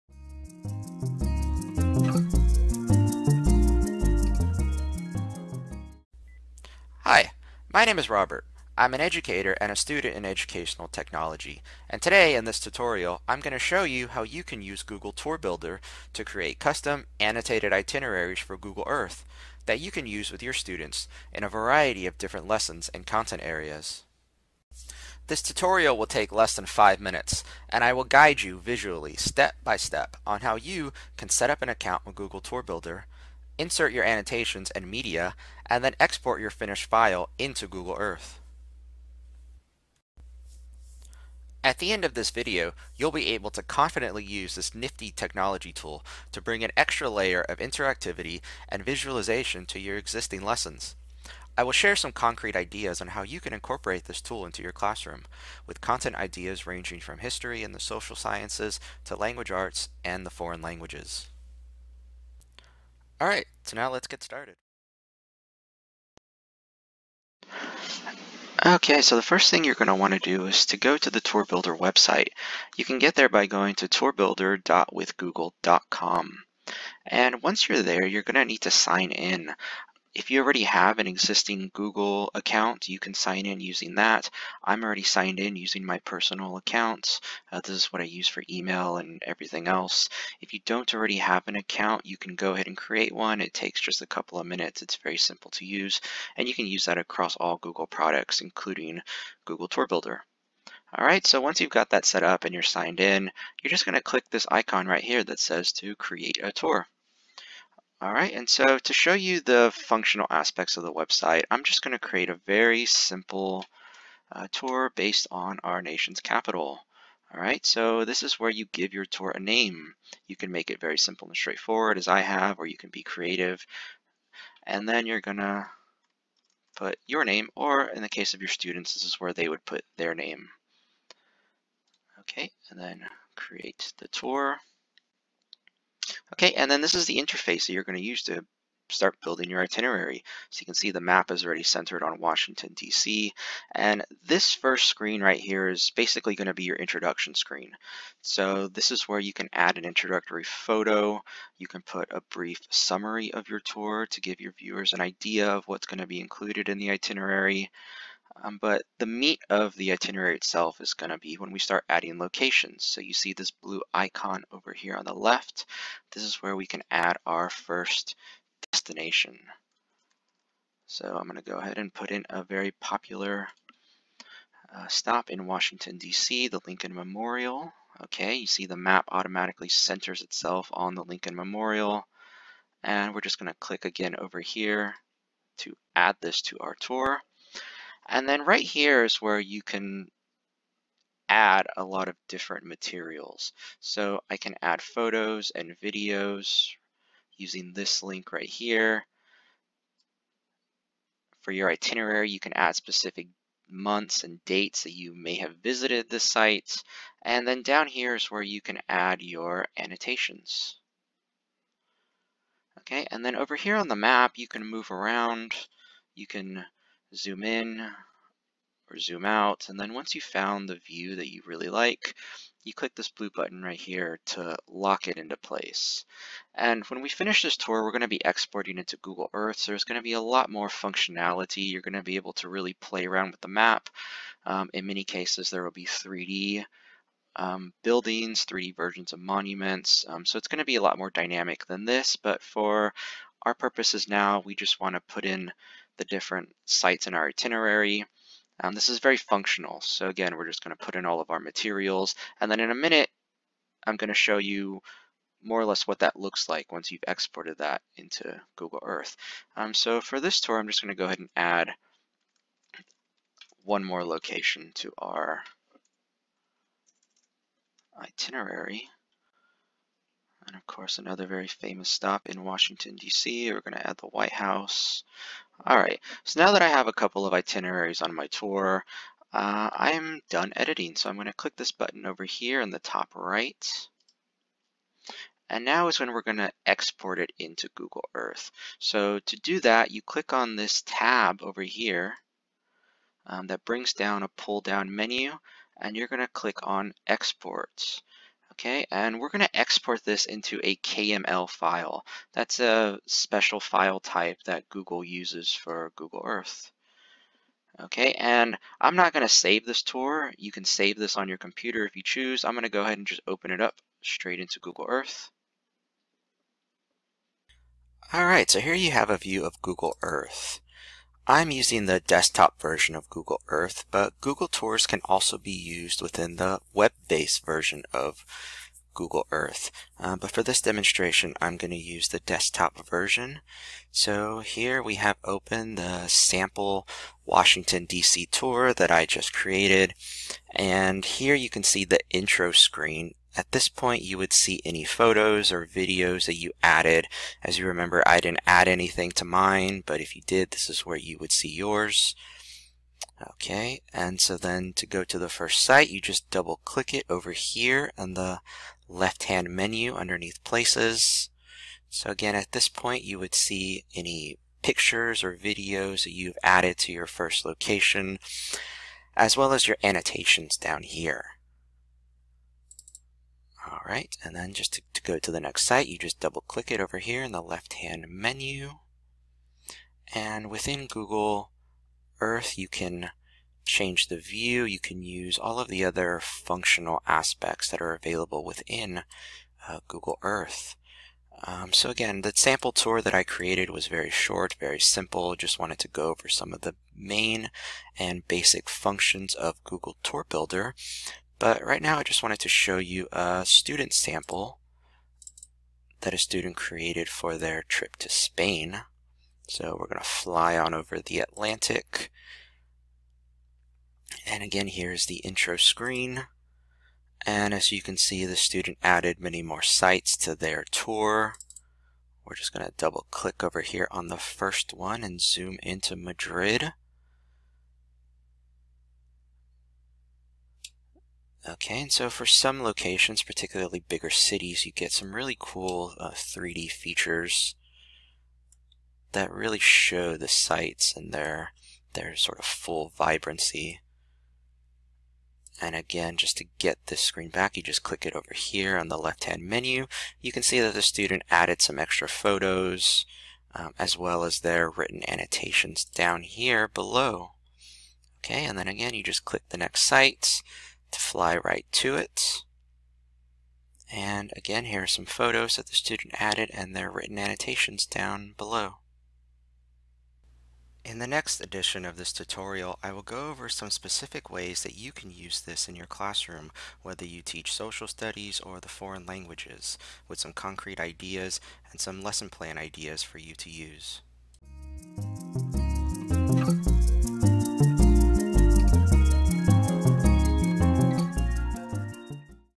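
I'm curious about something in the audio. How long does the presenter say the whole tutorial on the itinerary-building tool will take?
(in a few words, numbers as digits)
less than 5 minutes.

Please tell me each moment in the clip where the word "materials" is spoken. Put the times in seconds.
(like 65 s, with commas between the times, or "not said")
192 s, 251 s.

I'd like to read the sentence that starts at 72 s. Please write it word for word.
You can get there by going to tourbuilder.withgoogle.com.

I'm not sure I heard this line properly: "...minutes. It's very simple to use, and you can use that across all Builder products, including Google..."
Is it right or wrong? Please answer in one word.
wrong.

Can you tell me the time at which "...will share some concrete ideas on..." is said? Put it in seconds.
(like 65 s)
51 s.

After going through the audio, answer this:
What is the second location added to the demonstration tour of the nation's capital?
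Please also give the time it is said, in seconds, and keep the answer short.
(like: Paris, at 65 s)
The White House, at 273 s.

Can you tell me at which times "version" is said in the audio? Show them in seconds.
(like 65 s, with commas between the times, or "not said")
238 s, 322 s, 327 s, 332 s.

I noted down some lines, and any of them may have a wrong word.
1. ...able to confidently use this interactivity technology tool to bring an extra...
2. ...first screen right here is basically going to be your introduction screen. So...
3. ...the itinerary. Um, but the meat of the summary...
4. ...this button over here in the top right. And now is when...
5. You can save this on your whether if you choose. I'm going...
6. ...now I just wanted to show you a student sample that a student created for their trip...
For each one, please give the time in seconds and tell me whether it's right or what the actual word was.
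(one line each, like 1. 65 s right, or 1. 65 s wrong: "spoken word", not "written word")
1. 43 s wrong: "nifty", not "interactivity"
2. 144 s right
3. 156 s wrong: "itinerary", not "summary"
4. 281 s right
5. 310 s wrong: "computer", not "whether"
6. 401 s right.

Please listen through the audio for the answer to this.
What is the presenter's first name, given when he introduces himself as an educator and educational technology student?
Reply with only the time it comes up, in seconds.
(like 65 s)
8 s.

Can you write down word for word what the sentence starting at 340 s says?
And here you can see the intro screen at this point, you would see any photos or videos that you added.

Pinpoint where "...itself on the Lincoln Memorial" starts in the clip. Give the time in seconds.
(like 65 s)
180 s.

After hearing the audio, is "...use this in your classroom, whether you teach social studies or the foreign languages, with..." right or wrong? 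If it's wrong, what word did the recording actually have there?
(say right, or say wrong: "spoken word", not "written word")
right.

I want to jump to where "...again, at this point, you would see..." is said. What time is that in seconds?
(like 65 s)
362 s.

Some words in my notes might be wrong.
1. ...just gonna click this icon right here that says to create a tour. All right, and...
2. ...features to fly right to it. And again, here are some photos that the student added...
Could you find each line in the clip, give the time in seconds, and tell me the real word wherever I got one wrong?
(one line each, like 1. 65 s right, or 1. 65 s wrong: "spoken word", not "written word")
1. 103 s right
2. 459 s wrong: "sites", not "features".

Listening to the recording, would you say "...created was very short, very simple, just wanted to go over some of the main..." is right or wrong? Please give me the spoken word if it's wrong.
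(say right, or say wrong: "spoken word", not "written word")
right.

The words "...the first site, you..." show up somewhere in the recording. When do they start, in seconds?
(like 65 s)
355 s.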